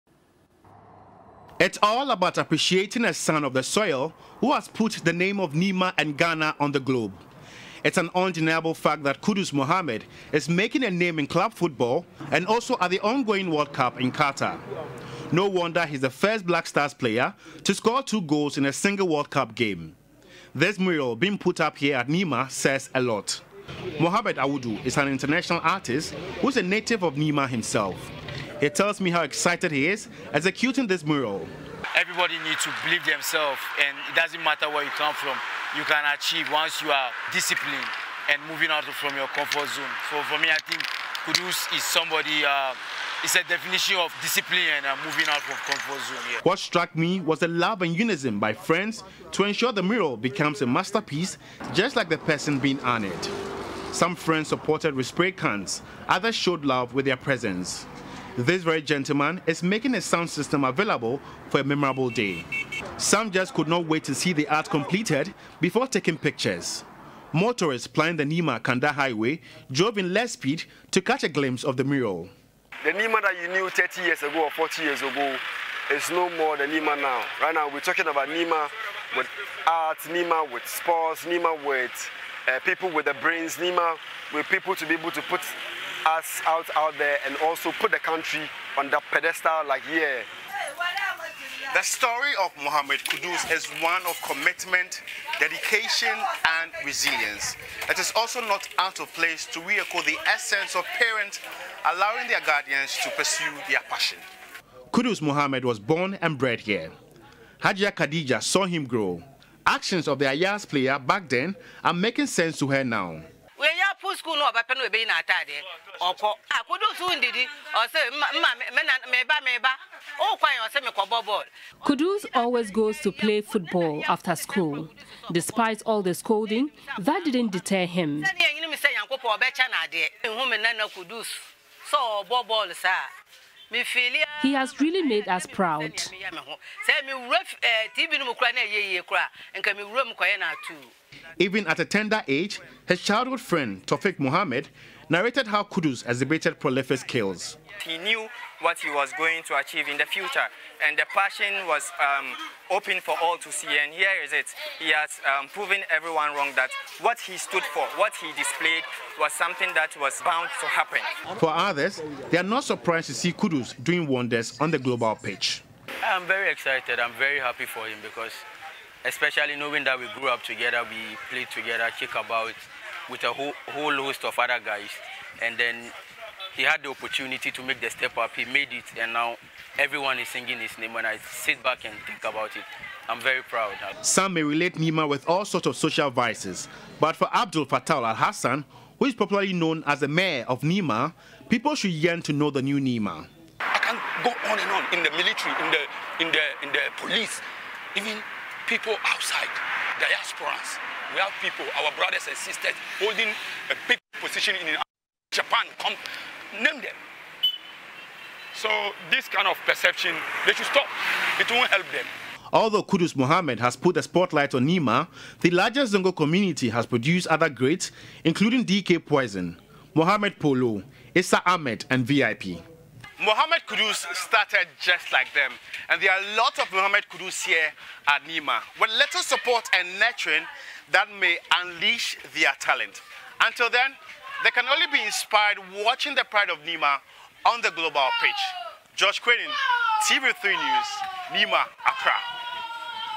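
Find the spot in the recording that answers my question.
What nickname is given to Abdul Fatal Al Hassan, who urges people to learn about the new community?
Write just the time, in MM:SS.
03:10.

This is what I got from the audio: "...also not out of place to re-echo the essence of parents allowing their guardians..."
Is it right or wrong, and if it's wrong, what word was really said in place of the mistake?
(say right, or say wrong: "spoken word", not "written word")
right.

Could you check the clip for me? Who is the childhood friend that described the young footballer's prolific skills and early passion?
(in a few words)
Tofik Muhammad.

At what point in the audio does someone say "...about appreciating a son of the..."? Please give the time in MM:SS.
00:02.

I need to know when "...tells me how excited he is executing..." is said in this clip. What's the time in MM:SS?
00:28.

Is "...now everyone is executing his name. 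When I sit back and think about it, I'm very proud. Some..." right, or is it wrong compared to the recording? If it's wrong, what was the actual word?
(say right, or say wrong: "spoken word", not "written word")
wrong: "singing", not "executing".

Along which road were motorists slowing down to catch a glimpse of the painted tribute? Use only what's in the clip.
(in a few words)
Nima Kanda Highway.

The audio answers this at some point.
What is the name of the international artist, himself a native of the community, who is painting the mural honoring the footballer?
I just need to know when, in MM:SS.
00:23.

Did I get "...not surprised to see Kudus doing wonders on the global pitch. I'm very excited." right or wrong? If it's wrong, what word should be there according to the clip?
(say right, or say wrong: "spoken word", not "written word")
right.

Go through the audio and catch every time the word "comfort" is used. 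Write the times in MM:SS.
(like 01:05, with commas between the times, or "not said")
00:39, 00:45.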